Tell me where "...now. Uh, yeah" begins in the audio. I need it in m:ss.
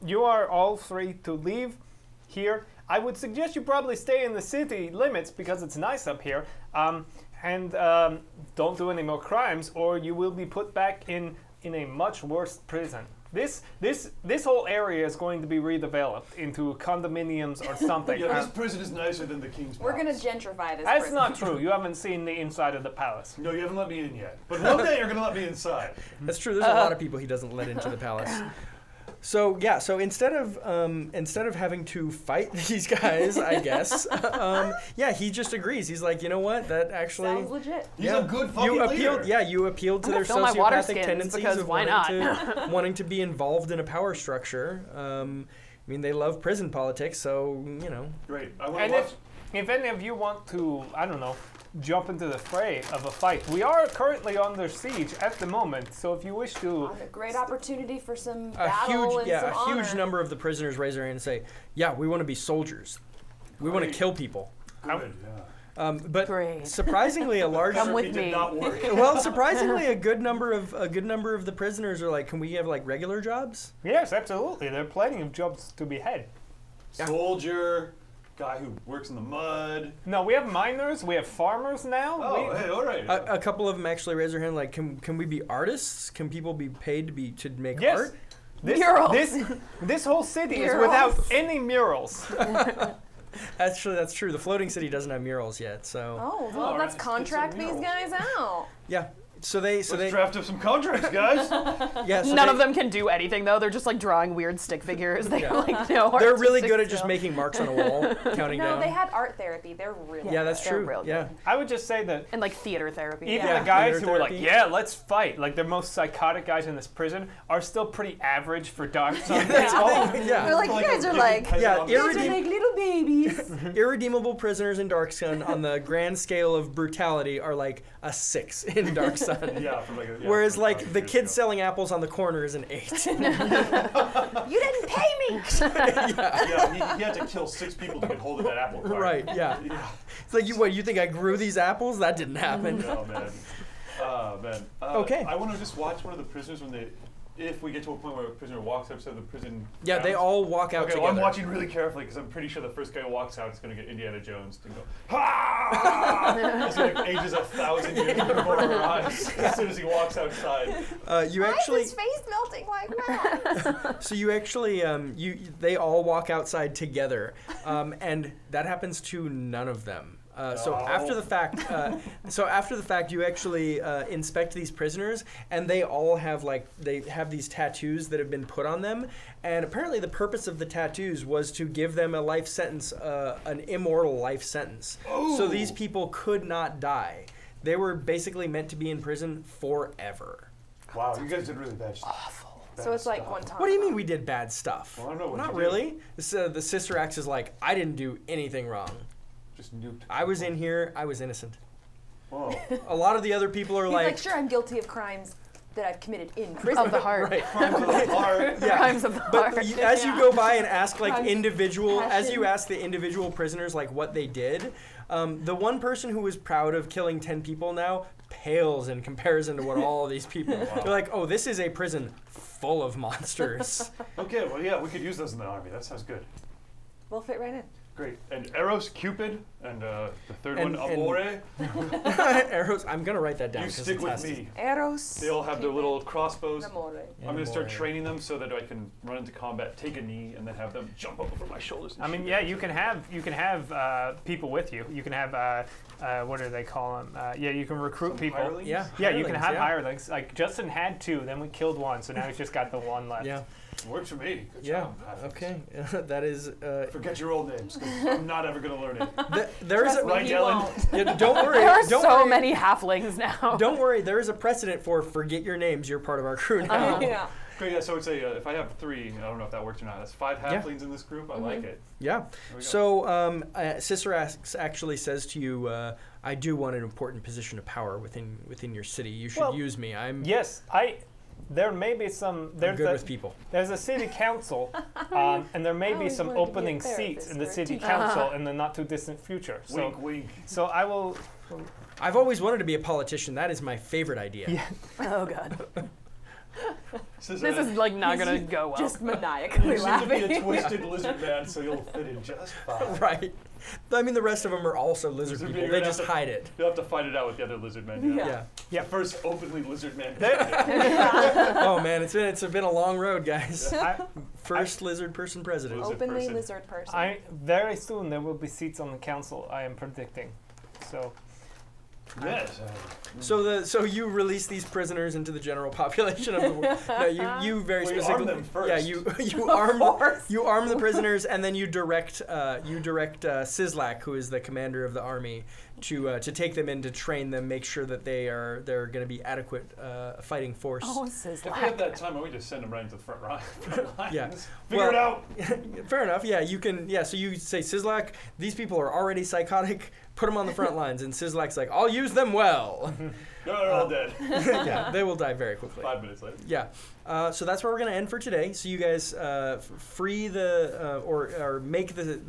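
4:26.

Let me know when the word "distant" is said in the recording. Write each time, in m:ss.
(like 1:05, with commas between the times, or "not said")
4:48.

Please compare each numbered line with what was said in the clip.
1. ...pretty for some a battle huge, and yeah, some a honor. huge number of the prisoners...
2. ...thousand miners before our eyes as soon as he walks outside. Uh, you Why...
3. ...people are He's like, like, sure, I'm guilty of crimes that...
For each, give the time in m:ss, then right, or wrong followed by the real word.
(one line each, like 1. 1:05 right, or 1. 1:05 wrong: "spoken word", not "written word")
1. 0:57 wrong: "opportunity", not "pretty"
2. 2:37 wrong: "years", not "miners"
3. 3:23 right.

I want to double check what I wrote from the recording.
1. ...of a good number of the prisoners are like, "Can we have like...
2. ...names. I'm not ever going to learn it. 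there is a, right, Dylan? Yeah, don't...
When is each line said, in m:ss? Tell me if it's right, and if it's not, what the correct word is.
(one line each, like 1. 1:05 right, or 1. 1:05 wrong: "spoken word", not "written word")
1. 1:10 right
2. 4:17 right.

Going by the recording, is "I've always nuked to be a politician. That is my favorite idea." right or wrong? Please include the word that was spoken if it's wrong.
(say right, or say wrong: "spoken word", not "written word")
wrong: "wanted", not "nuked".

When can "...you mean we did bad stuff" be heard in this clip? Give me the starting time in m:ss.
3:13.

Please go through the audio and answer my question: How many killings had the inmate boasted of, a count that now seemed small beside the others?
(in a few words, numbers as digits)
10.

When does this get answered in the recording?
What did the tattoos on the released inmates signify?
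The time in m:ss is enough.
3:03.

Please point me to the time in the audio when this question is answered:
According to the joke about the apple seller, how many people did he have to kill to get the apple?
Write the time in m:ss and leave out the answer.
2:17.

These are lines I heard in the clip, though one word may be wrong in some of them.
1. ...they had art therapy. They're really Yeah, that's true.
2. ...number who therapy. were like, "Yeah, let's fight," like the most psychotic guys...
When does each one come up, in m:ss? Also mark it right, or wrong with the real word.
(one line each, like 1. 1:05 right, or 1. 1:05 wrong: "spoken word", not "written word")
1. 1:48 right
2. 1:53 wrong: "theater", not "number".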